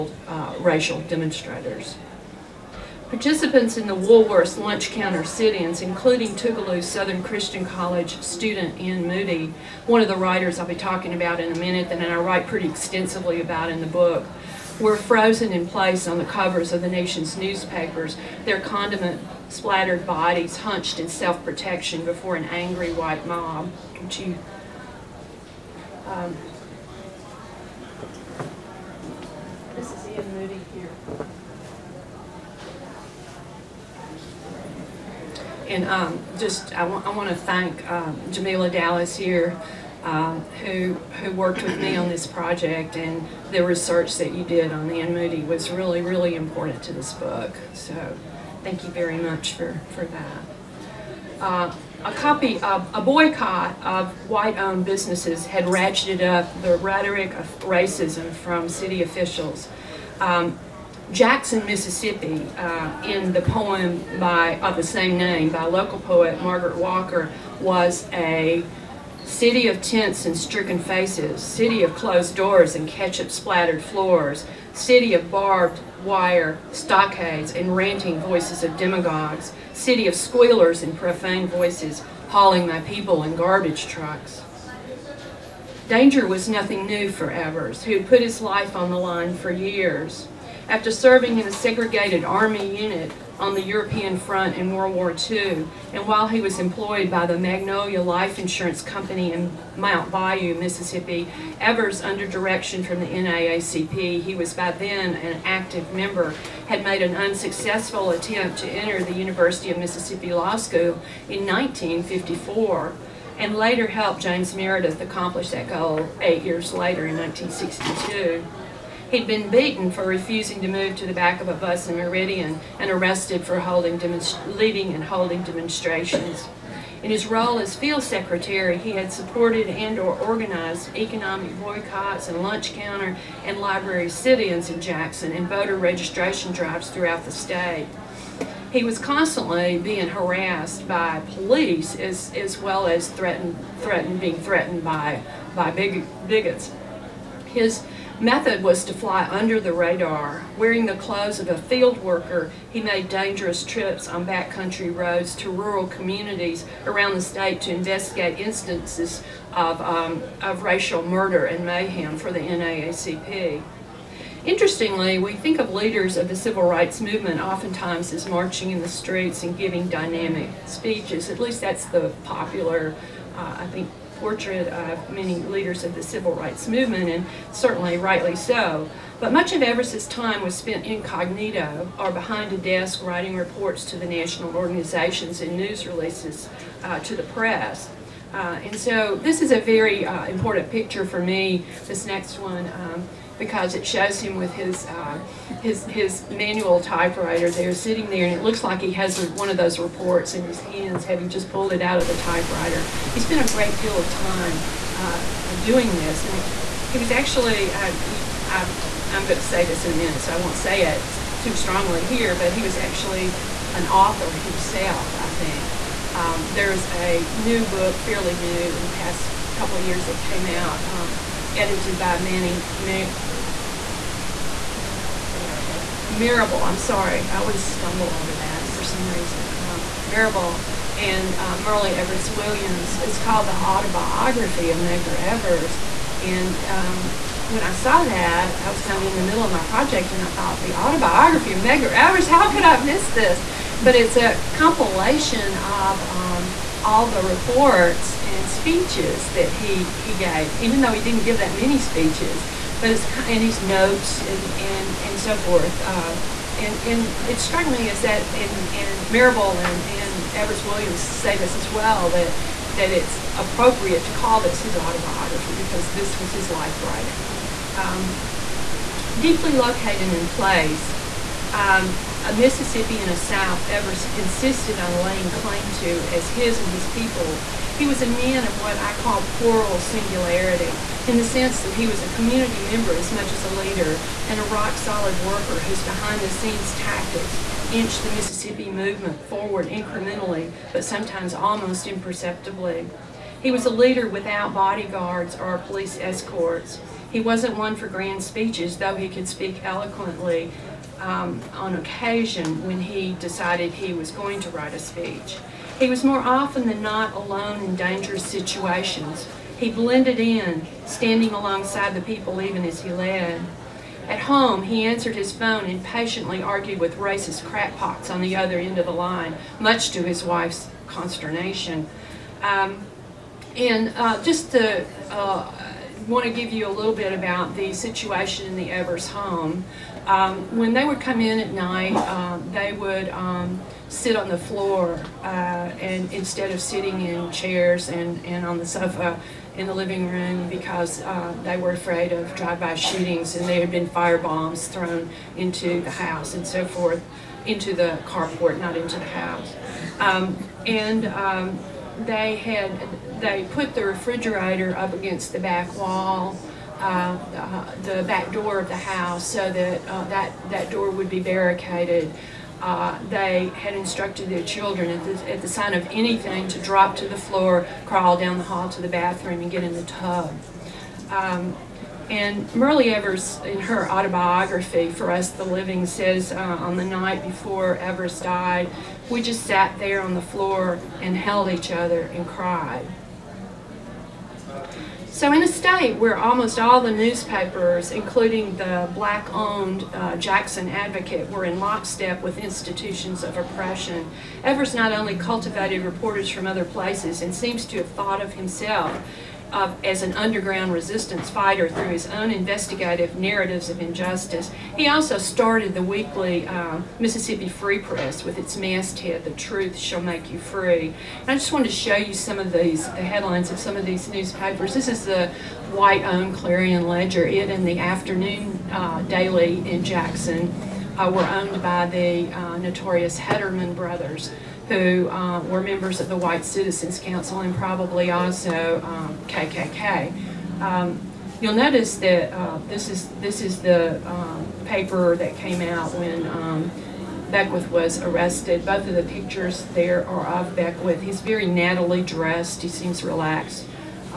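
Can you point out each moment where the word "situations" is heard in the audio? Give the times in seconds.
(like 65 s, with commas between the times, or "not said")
308 s, 327 s.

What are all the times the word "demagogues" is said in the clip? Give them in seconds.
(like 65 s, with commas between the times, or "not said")
78 s.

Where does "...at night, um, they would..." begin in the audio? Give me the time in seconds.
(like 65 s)
331 s.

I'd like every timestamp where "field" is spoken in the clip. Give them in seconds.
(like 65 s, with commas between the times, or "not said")
127 s, 151 s.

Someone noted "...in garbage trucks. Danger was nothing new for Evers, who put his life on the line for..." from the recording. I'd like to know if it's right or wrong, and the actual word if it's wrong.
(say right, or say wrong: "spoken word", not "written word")
right.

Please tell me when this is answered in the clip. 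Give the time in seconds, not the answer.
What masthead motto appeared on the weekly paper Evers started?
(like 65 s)
409 s.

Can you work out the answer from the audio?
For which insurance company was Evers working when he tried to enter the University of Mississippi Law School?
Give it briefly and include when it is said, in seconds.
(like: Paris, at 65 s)
Magnolia Life Insurance Company, at 97 s.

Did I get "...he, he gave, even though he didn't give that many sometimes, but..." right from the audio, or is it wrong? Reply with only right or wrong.
wrong.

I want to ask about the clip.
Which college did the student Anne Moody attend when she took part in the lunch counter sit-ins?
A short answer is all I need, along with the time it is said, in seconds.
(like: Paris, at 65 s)
Tougaloo Southern Christian College, at 6 s.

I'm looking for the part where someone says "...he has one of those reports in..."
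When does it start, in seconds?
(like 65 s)
198 s.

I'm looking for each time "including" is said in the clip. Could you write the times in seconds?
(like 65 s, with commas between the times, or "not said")
5 s, 387 s.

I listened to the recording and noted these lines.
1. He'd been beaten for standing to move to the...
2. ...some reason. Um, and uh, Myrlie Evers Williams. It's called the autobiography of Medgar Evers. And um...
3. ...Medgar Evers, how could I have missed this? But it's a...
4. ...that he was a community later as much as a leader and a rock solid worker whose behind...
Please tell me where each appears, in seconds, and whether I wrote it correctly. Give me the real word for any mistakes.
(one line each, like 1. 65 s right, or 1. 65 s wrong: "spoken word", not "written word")
1. 119 s wrong: "refusing", not "standing"
2. 228 s right
3. 241 s right
4. 281 s wrong: "member", not "later".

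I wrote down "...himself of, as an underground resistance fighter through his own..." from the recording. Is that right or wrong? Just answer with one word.
right.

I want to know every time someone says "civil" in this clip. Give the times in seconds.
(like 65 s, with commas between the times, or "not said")
166 s, 176 s.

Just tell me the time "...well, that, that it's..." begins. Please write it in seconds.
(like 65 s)
261 s.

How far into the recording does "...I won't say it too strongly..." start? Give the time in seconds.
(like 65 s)
210 s.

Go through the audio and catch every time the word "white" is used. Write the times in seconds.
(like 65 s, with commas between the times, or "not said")
22 s, 54 s, 415 s, 426 s.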